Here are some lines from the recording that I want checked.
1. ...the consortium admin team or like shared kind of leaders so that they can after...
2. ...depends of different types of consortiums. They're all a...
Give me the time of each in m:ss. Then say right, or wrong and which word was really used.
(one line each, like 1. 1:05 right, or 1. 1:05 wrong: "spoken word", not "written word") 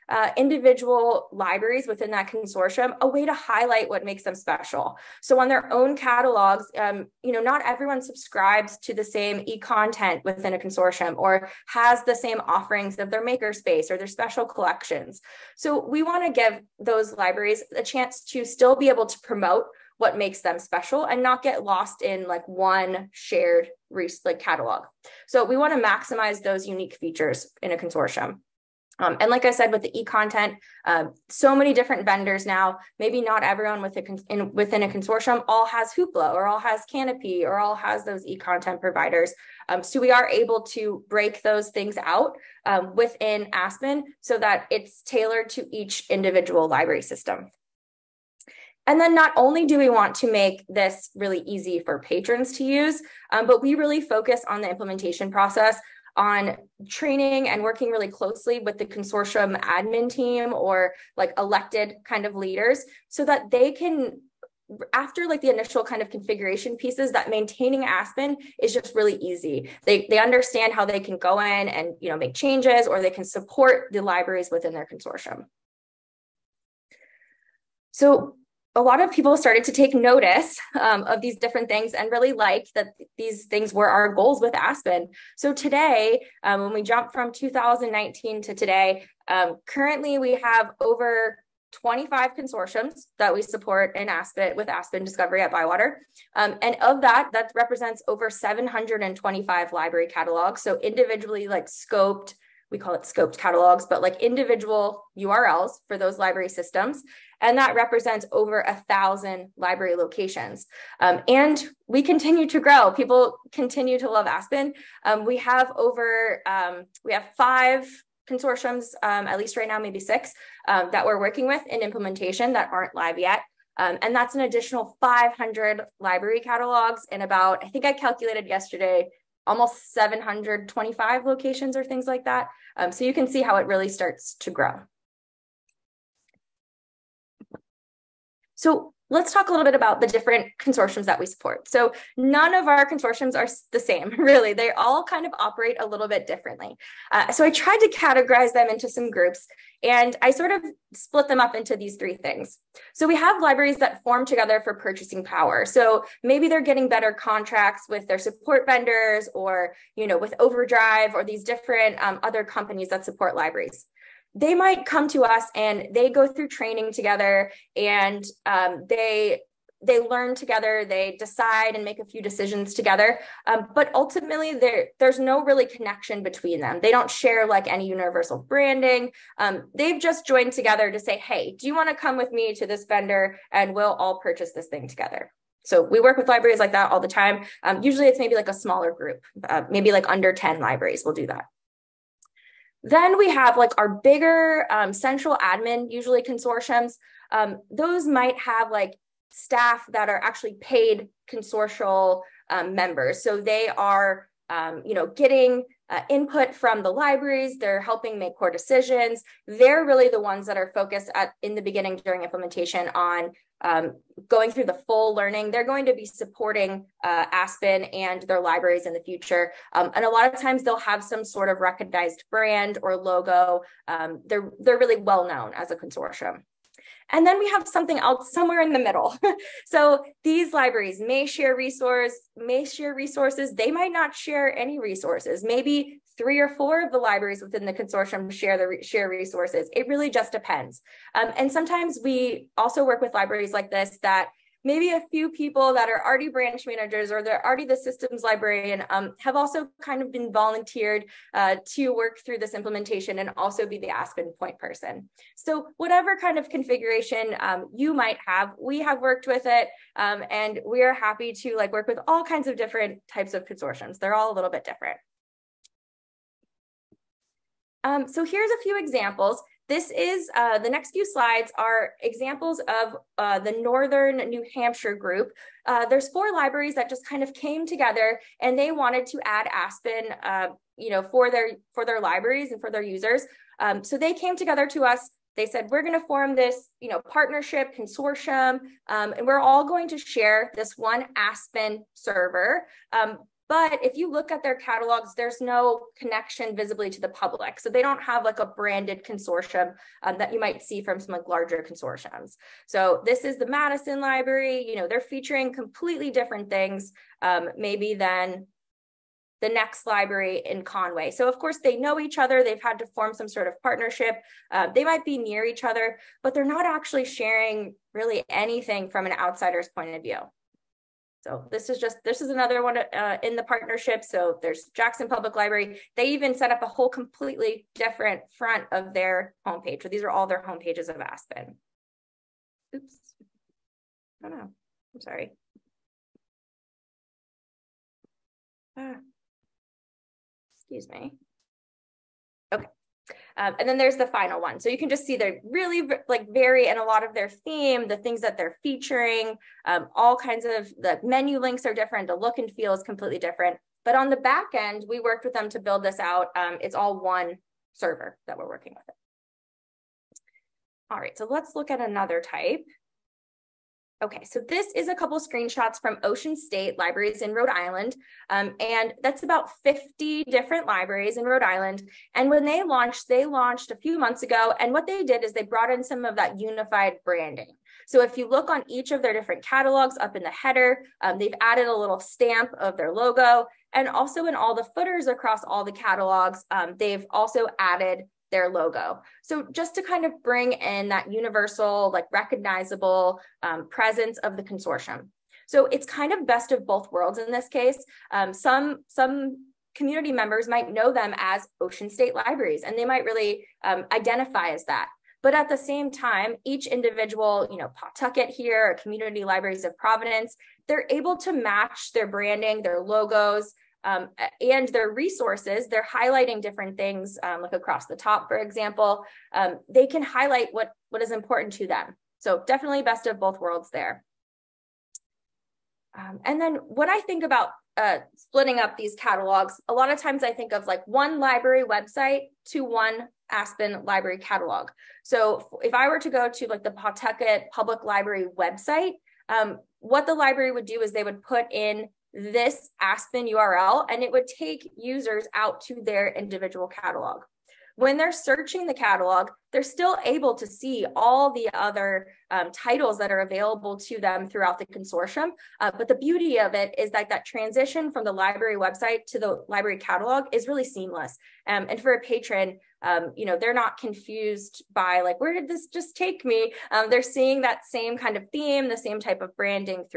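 1. 0:58 wrong: "elected", not "shared"
2. 4:22 wrong: "kinds", not "depends".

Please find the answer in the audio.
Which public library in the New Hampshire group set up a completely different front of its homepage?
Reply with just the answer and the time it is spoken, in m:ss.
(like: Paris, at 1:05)
Jackson Public Library, at 5:24.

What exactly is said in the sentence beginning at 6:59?
Um, they can highlight what, what is important to them.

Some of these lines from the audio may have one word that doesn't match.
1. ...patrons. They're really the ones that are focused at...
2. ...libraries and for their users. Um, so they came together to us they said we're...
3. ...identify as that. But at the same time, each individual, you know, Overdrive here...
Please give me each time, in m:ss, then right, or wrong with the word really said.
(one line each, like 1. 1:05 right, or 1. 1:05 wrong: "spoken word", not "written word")
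1. 3:28 wrong: "decisions", not "patrons"
2. 4:41 right
3. 6:43 wrong: "Pawtucket", not "Overdrive".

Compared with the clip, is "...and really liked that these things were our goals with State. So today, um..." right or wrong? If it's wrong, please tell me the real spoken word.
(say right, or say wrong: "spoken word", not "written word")
wrong: "Aspen", not "State".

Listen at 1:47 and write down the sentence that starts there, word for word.
And that represents over a thousand library locations.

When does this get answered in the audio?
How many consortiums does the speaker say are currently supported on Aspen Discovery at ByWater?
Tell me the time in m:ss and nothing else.
1:31.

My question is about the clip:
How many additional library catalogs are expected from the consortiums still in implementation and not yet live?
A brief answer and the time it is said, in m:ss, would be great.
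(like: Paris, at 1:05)
500, at 2:04.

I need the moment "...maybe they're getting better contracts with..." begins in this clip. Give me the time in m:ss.
2:36.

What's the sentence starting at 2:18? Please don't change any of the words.
So let's talk a little bit about the different consortiums that we support.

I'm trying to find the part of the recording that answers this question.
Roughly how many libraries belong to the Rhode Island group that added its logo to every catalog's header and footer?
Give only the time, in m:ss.
6:09.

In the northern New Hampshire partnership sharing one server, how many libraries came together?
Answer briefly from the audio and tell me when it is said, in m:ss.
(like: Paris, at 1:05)
4, at 4:36.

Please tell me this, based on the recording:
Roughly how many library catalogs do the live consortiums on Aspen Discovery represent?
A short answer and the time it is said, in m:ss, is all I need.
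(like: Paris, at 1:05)
over 725, at 1:38.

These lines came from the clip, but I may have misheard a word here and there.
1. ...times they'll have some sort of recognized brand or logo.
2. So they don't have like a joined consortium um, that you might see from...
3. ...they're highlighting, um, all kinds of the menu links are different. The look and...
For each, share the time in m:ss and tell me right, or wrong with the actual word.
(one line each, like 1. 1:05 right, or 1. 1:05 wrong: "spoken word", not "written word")
1. 3:40 right
2. 4:57 wrong: "branded", not "joined"
3. 5:48 wrong: "featuring", not "highlighting".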